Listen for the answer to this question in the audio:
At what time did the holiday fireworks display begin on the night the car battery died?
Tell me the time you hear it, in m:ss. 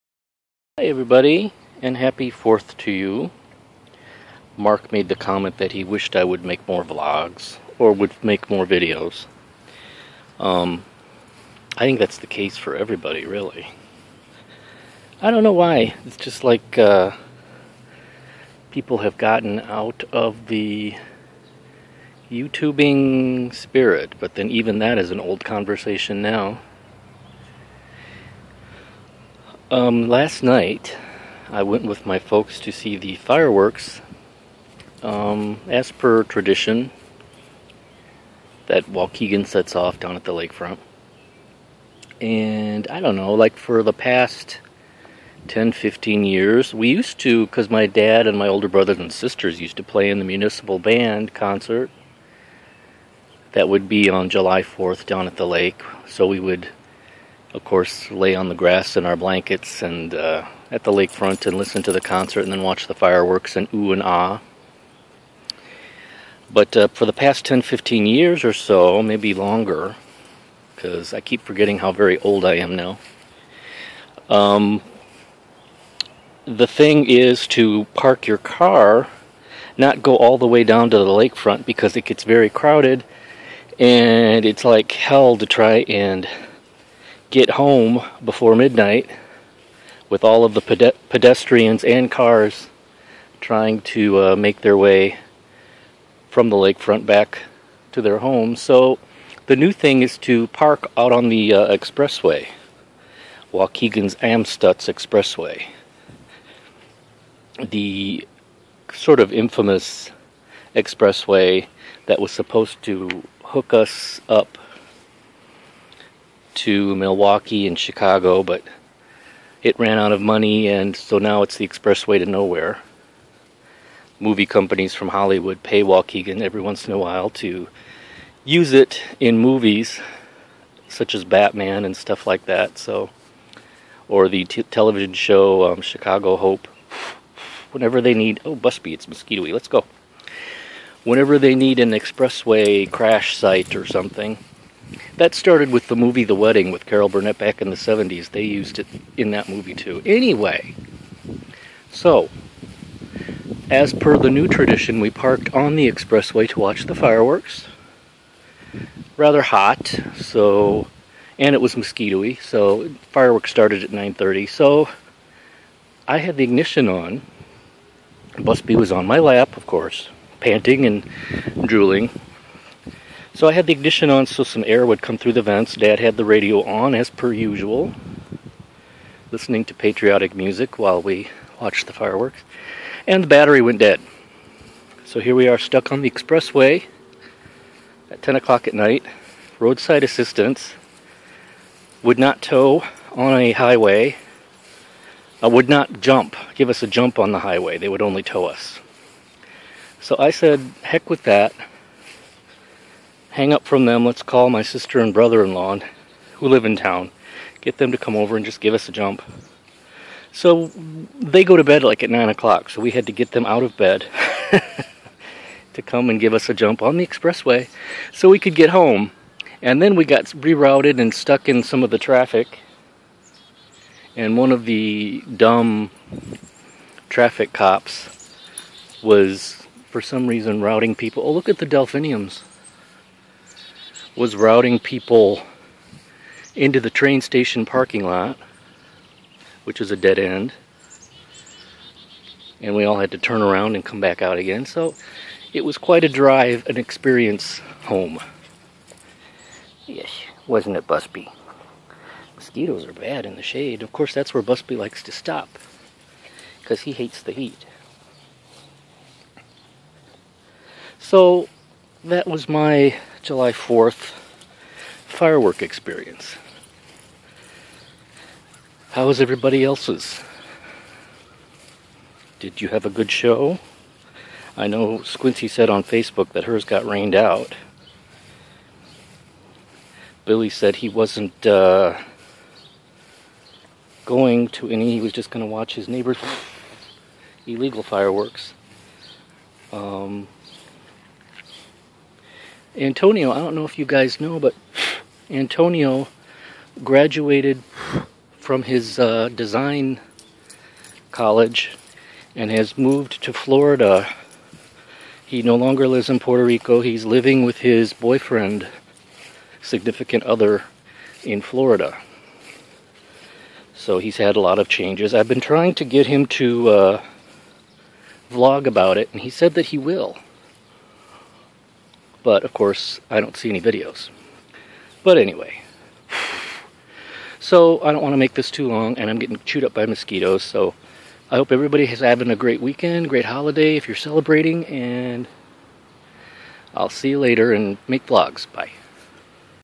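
2:43.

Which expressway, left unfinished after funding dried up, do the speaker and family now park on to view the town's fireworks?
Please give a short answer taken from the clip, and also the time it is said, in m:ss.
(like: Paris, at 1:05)
Amstutz Expressway, at 1:44.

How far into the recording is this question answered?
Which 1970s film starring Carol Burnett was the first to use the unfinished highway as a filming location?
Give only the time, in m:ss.
2:26.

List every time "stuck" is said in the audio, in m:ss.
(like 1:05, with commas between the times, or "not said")
3:05, 3:41.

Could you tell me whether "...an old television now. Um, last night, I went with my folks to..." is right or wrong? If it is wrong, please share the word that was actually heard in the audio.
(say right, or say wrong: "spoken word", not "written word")
wrong: "conversation", not "television".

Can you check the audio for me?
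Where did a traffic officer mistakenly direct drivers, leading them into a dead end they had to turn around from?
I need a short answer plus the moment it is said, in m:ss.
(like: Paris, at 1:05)
train station parking lot, at 3:56.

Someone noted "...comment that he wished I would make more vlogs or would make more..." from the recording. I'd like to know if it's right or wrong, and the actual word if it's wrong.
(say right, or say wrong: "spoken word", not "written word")
right.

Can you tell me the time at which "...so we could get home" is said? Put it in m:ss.
3:38.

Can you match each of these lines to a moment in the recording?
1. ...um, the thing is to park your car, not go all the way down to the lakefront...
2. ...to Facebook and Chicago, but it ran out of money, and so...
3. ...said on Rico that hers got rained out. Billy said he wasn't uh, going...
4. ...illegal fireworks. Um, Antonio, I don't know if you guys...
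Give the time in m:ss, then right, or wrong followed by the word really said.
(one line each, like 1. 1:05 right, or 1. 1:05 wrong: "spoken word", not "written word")
1. 1:14 right
2. 1:56 wrong: "Milwaukee", not "Facebook"
3. 4:35 wrong: "Facebook", not "Rico"
4. 4:47 right.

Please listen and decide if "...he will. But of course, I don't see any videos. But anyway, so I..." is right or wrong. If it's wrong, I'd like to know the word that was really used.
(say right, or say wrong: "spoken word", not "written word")
right.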